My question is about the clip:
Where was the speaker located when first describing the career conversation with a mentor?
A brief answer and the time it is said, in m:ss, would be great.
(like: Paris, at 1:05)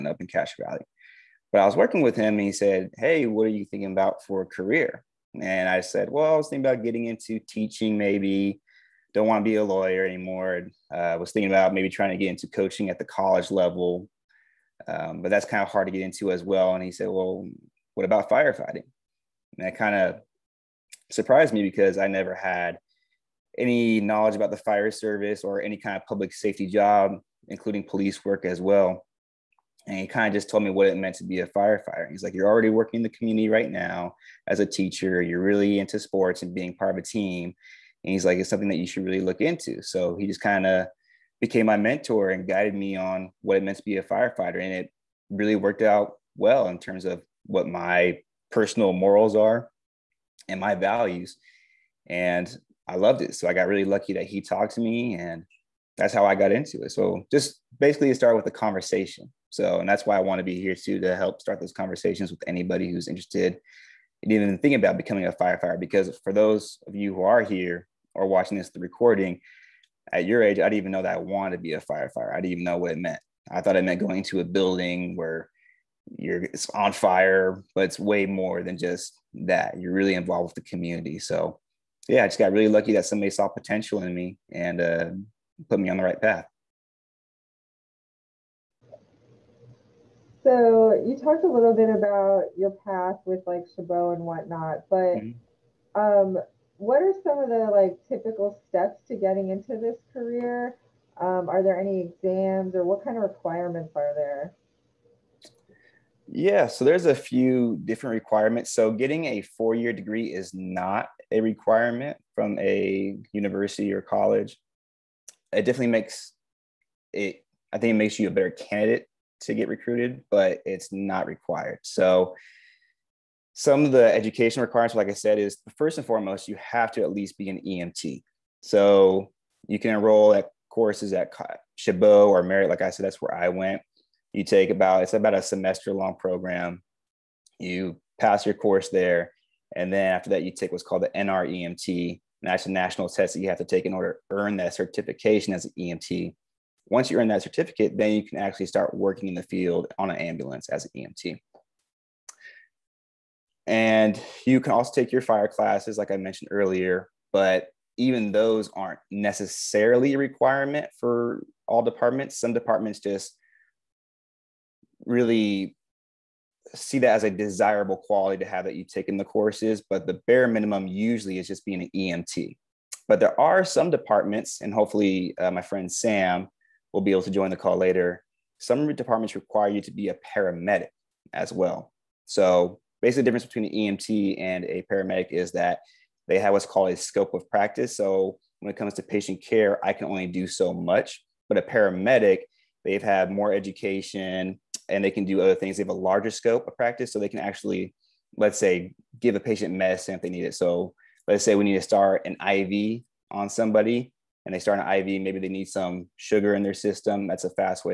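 Castro Valley, at 0:00.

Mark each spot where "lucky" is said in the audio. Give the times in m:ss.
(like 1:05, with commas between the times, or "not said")
0:53, 1:22.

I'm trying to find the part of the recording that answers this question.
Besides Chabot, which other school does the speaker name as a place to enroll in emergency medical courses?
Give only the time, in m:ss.
2:12.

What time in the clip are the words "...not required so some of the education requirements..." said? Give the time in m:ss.
2:00.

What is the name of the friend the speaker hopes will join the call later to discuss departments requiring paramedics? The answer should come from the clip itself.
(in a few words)
Sam.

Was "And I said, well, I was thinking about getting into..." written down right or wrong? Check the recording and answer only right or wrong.
right.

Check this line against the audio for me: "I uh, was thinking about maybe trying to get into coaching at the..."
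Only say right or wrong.
right.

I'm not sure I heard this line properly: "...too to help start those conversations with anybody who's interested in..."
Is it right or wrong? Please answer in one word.
right.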